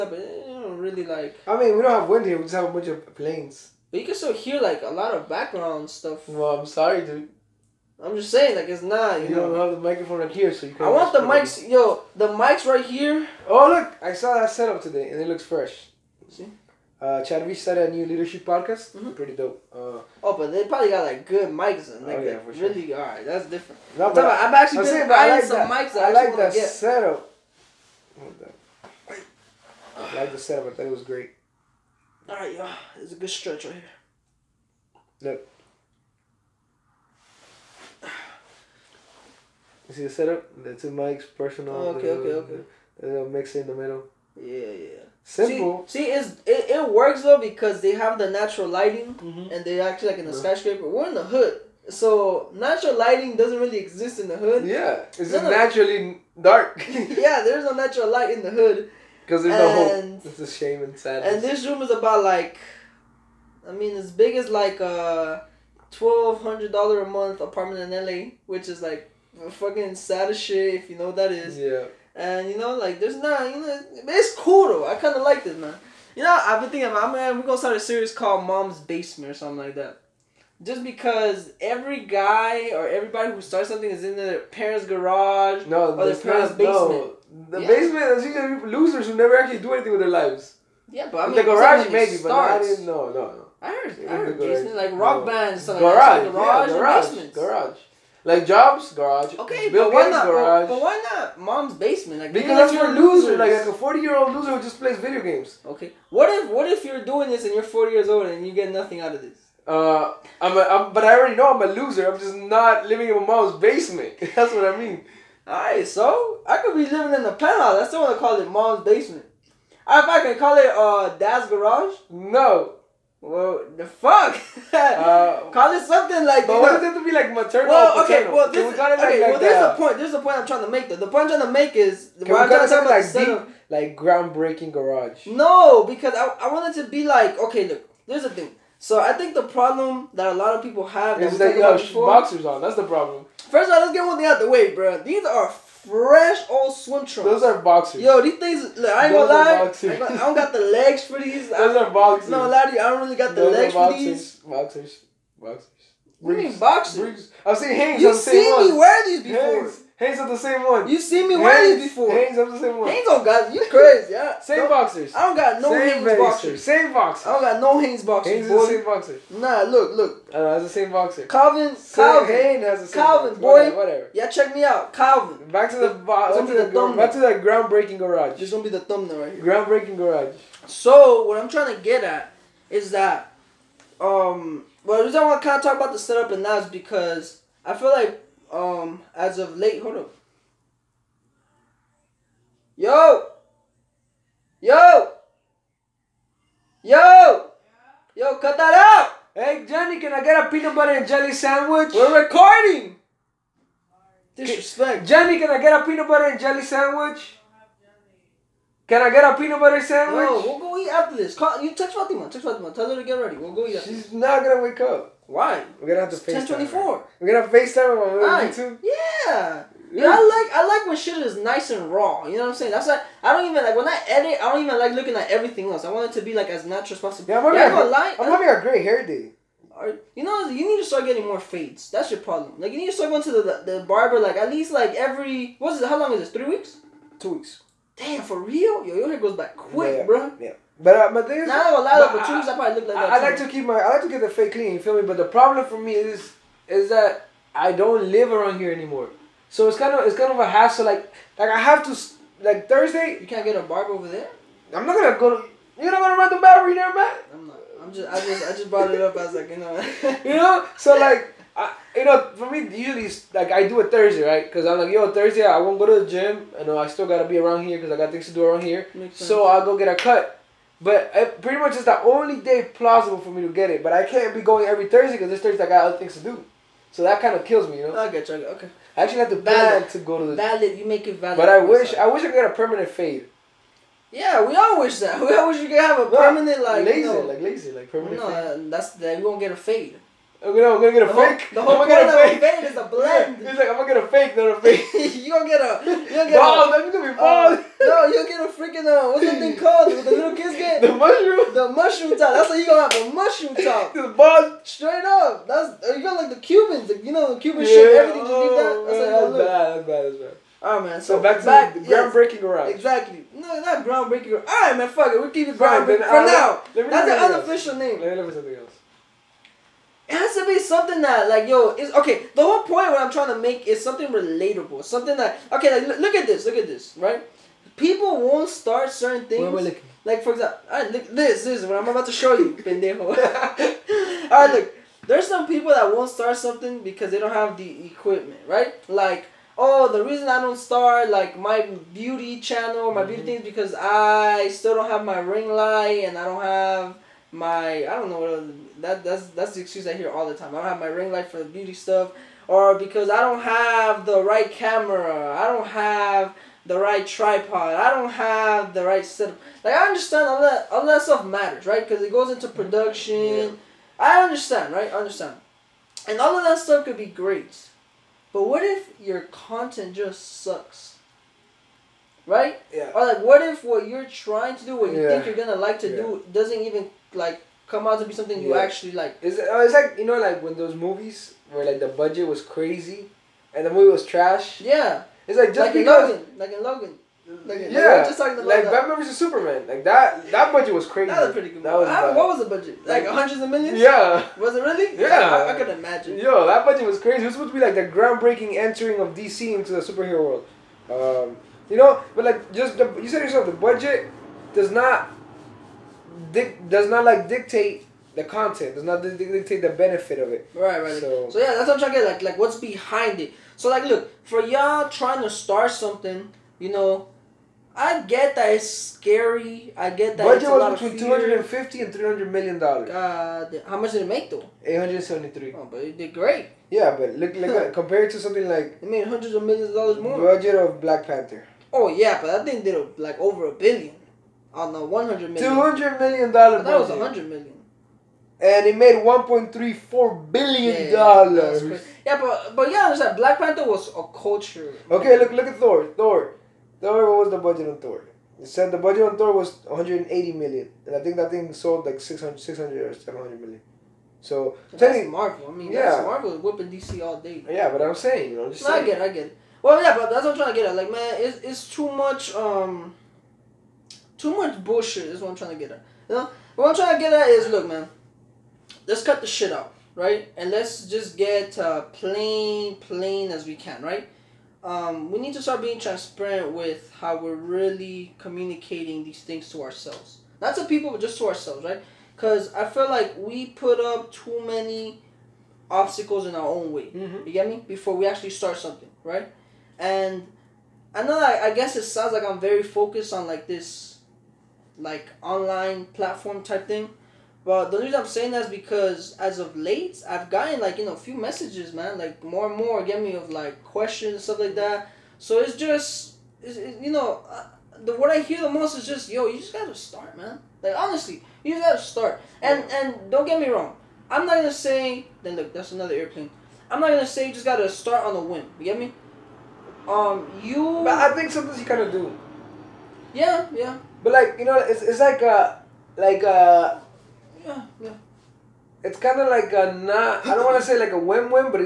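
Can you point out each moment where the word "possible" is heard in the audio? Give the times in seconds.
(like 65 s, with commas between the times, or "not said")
227 s.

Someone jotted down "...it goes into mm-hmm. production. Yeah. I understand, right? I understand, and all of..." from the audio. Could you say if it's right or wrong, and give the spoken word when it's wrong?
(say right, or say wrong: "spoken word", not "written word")
right.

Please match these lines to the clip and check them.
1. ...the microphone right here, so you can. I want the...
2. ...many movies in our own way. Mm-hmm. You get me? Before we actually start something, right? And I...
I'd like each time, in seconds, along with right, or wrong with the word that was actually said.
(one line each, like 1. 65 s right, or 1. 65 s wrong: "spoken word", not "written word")
1. 9 s right
2. 484 s wrong: "obstacles", not "movies".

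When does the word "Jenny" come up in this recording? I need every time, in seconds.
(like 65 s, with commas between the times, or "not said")
199 s, 205 s.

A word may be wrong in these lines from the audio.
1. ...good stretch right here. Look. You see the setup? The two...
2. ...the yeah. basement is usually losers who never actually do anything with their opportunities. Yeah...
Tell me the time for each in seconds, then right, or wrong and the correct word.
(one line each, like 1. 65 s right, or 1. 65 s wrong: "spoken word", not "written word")
1. 33 s right
2. 87 s wrong: "lives", not "opportunities".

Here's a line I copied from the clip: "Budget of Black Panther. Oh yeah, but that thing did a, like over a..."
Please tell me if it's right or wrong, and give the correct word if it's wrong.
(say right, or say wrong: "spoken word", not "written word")
right.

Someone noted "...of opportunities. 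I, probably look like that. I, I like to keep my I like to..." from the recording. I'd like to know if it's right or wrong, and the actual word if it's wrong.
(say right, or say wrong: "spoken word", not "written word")
right.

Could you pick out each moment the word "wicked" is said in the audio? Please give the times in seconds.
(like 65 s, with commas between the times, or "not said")
not said.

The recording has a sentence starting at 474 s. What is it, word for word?
Um, we need to start being transparent with how we're really communicating these things to ourselves.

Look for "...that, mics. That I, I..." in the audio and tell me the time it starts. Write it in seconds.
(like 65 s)
25 s.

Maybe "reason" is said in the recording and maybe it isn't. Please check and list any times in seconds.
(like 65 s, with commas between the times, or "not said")
185 s, 340 s, 497 s.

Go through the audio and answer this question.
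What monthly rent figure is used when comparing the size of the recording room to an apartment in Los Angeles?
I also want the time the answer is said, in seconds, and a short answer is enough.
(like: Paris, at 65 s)
$1,200, at 65 s.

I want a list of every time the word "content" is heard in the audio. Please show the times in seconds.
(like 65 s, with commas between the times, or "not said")
369 s, 408 s.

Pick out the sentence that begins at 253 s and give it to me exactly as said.
You can't get a barber over there.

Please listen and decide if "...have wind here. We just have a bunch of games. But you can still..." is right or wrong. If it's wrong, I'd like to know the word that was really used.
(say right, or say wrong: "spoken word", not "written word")
wrong: "planes", not "games".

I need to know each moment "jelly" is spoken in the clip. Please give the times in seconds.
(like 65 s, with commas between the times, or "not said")
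201 s, 206 s.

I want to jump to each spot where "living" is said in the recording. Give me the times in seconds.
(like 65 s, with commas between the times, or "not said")
112 s, 116 s.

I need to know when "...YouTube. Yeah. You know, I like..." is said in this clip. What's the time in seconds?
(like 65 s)
218 s.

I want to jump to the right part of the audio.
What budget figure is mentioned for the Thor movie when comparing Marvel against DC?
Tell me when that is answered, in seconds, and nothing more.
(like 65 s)
449 s.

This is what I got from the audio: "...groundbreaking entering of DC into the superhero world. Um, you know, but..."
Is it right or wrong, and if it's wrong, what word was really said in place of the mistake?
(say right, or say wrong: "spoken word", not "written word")
right.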